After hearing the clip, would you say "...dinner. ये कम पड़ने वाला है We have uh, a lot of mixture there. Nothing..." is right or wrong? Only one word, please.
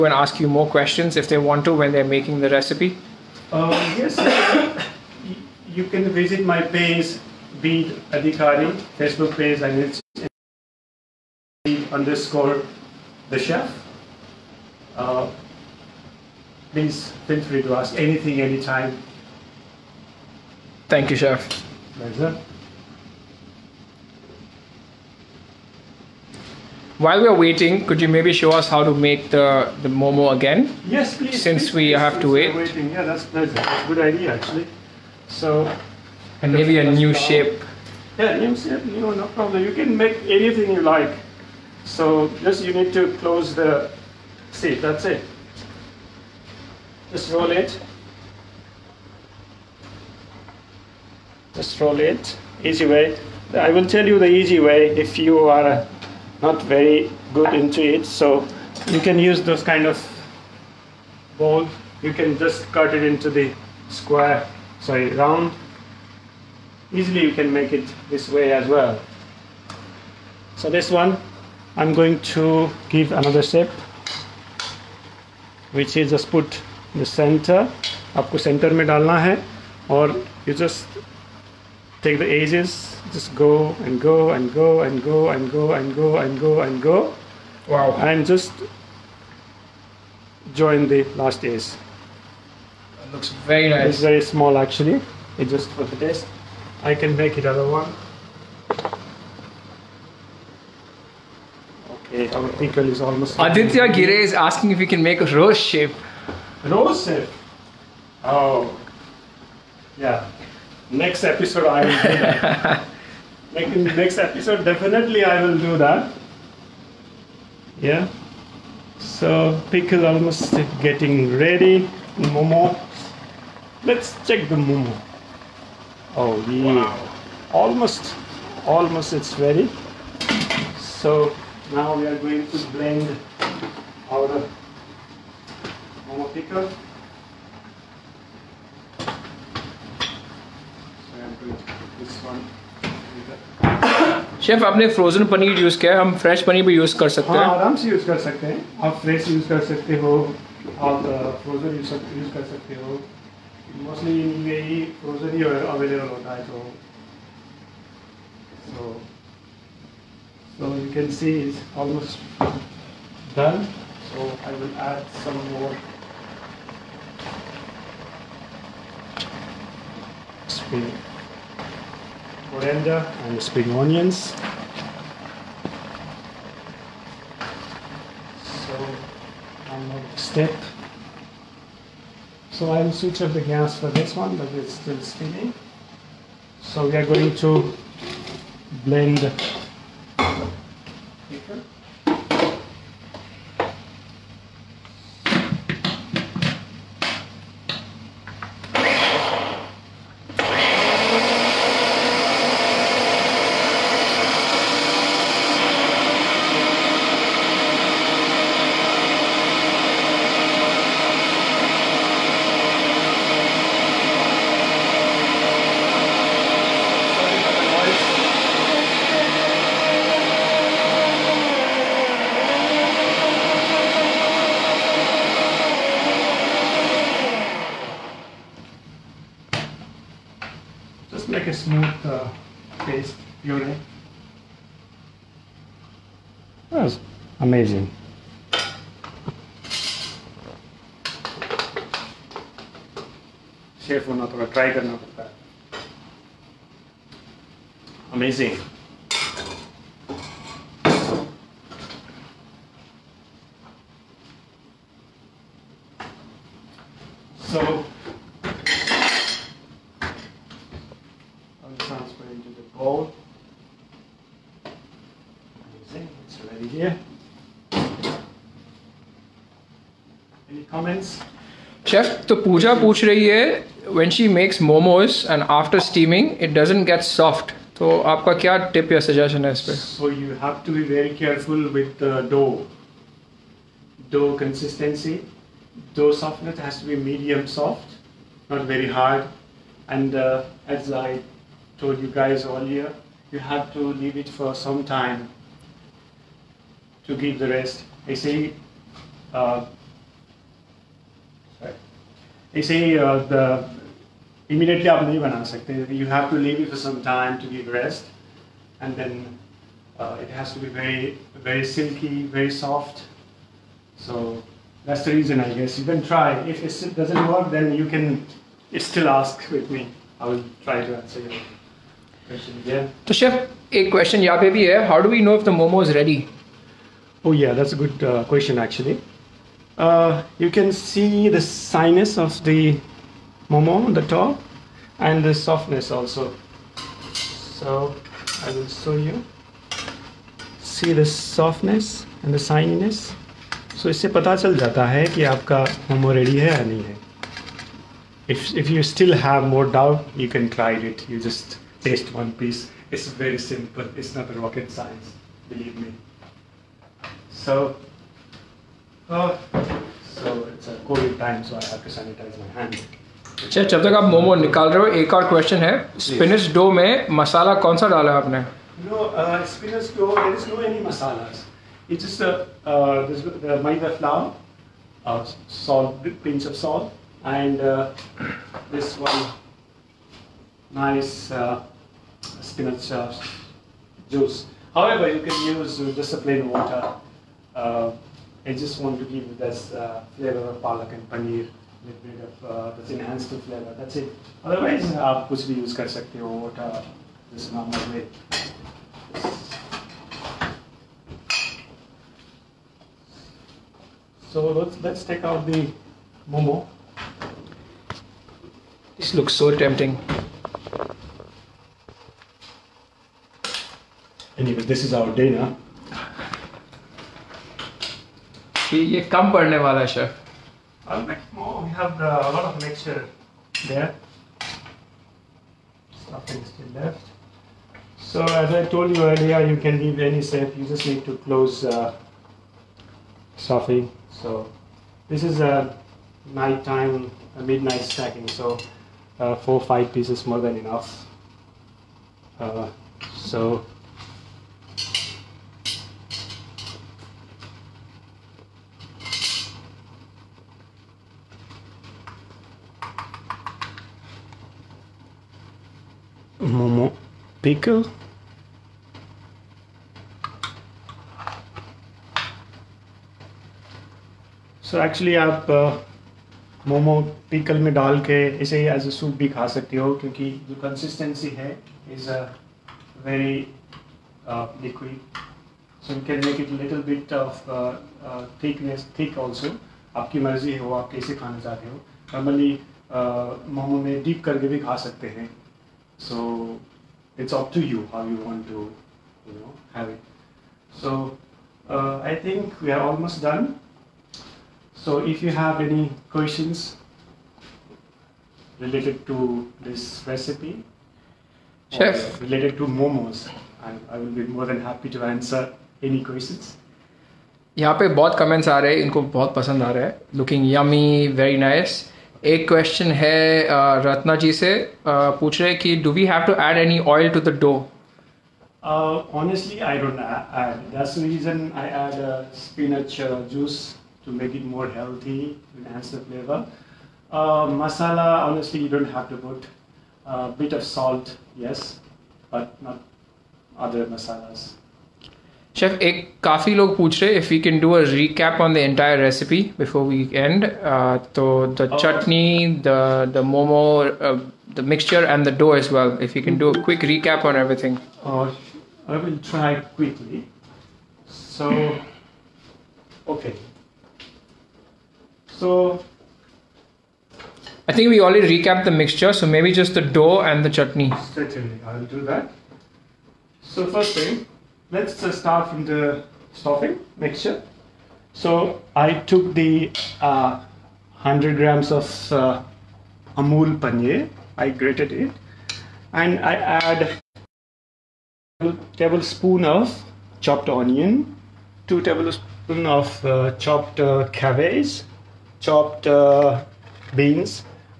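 right.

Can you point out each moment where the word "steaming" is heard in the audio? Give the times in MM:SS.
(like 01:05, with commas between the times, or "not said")
03:05, 04:35.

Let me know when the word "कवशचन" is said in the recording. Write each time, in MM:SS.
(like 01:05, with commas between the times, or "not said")
06:05, 08:32.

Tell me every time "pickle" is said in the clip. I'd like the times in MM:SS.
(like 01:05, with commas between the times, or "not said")
01:42, 01:59, 02:16, 07:37.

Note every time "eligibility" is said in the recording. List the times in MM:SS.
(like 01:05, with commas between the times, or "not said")
not said.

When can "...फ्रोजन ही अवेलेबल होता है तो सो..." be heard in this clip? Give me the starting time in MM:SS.
02:35.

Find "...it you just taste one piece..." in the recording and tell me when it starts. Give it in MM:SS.
05:50.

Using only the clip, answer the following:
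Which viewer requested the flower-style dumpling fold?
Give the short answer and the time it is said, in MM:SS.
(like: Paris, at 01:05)
Aditya Gire, at 01:43.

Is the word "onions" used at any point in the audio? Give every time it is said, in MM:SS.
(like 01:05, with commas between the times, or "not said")
02:53, 09:40.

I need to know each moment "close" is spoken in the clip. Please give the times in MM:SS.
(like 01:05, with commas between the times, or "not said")
00:43, 07:11.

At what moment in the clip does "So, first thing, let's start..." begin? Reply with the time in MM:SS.
09:23.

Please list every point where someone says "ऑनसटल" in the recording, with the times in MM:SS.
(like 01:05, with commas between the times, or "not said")
08:39, 08:48.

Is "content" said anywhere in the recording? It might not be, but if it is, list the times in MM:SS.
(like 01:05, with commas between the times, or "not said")
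not said.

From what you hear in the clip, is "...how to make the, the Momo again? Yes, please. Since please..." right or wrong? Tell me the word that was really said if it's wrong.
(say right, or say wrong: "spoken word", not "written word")
right.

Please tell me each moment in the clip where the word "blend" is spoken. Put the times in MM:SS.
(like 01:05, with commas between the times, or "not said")
02:12, 03:08.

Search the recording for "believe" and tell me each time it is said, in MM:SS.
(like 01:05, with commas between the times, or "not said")
05:55.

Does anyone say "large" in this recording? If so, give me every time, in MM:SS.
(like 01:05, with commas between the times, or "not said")
not said.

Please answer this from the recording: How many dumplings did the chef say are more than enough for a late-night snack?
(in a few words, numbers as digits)
4 or 5.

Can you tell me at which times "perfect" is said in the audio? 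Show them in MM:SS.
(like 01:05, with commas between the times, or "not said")
not said.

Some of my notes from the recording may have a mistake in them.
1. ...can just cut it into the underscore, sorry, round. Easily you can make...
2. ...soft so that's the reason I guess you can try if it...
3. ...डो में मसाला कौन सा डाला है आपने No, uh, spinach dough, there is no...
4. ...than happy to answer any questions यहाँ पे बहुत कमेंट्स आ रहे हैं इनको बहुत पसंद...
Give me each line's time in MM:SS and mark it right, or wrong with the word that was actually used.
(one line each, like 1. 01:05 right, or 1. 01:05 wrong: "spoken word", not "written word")
1. 01:02 wrong: "square", not "underscore"
2. 05:12 right
3. 06:06 right
4. 08:24 right.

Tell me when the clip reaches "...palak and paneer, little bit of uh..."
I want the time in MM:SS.
06:30.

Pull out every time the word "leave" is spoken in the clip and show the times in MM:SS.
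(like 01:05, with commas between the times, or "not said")
04:54, 05:06, 07:09.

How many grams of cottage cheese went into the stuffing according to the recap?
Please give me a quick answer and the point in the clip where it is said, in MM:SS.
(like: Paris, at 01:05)
100 grams, at 09:31.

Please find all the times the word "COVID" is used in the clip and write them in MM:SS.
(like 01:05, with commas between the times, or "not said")
06:00.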